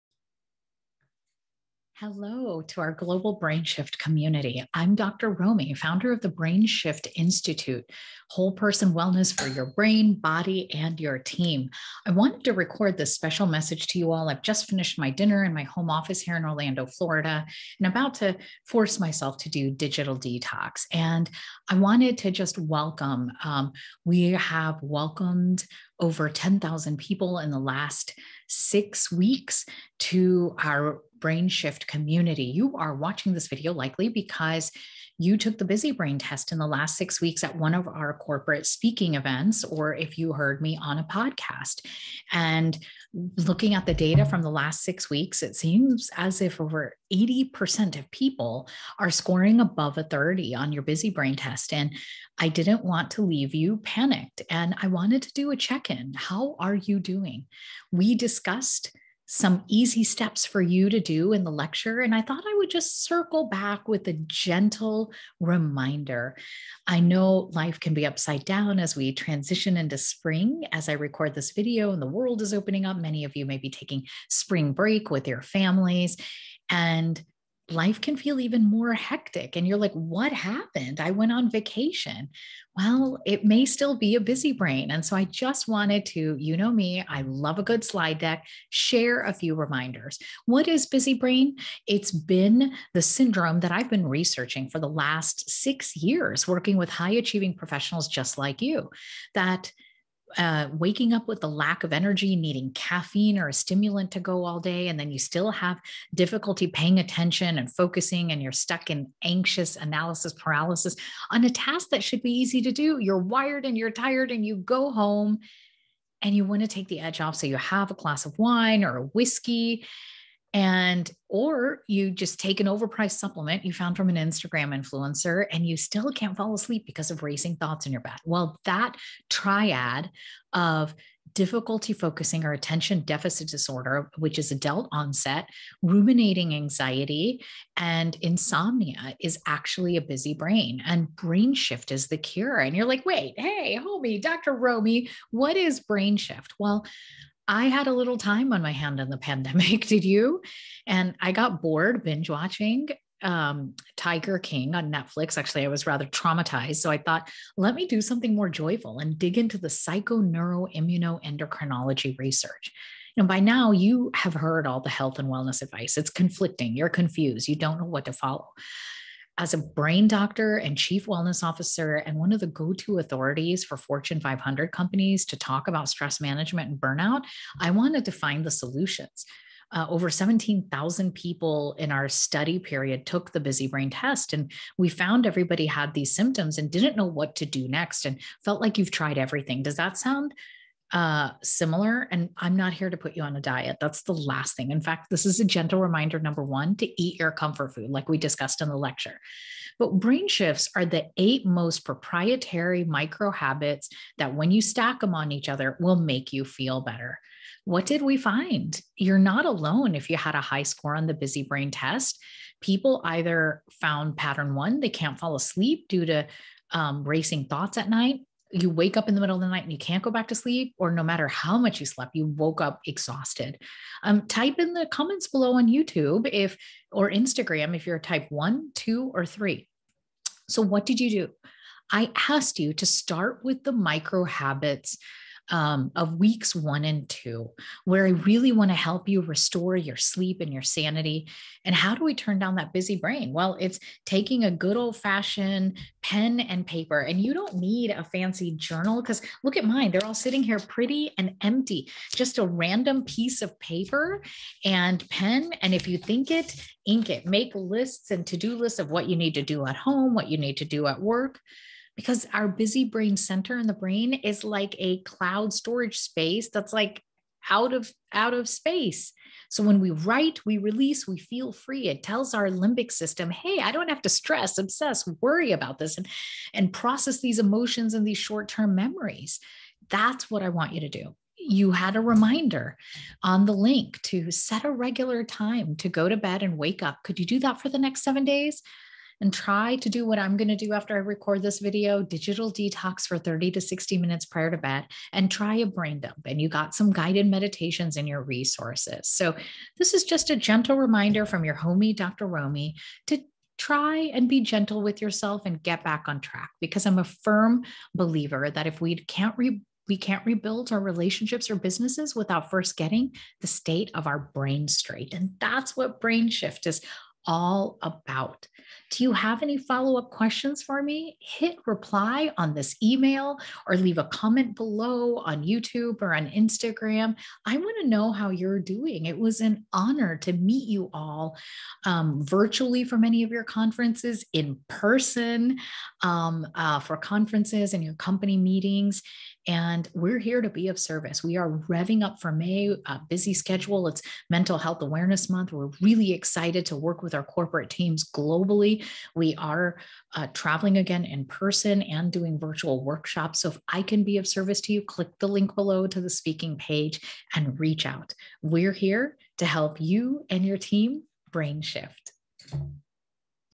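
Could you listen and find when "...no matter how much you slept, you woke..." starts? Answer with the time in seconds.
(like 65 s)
220 s.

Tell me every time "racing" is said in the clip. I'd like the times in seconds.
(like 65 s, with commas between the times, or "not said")
127 s, 217 s.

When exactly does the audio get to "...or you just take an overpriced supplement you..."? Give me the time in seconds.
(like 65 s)
121 s.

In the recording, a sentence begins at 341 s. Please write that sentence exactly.
We are revving up for May, a busy schedule.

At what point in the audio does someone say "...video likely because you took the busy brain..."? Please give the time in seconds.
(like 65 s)
33 s.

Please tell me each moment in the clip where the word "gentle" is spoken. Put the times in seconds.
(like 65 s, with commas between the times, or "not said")
64 s, 195 s, 300 s, 304 s.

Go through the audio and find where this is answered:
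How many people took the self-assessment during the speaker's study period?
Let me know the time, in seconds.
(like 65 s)
180 s.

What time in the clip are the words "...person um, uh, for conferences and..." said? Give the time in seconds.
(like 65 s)
334 s.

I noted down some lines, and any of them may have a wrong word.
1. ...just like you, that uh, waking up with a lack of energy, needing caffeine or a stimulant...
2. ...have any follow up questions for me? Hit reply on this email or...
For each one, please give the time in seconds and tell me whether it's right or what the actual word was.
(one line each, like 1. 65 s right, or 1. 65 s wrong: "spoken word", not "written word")
1. 98 s right
2. 319 s right.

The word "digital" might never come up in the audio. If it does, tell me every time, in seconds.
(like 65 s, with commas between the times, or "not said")
19 s, 292 s.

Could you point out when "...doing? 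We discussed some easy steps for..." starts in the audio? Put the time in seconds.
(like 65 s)
56 s.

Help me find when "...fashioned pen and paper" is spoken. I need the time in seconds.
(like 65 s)
244 s.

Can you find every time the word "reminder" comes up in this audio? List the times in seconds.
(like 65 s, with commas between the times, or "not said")
65 s, 89 s, 195 s, 282 s, 300 s.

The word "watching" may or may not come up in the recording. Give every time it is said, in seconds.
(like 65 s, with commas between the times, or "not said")
32 s, 152 s.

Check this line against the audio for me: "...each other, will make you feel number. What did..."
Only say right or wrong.
wrong.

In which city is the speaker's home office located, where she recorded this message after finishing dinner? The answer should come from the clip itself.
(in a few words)
Orlando, Florida.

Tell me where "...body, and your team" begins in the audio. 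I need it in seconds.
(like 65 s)
10 s.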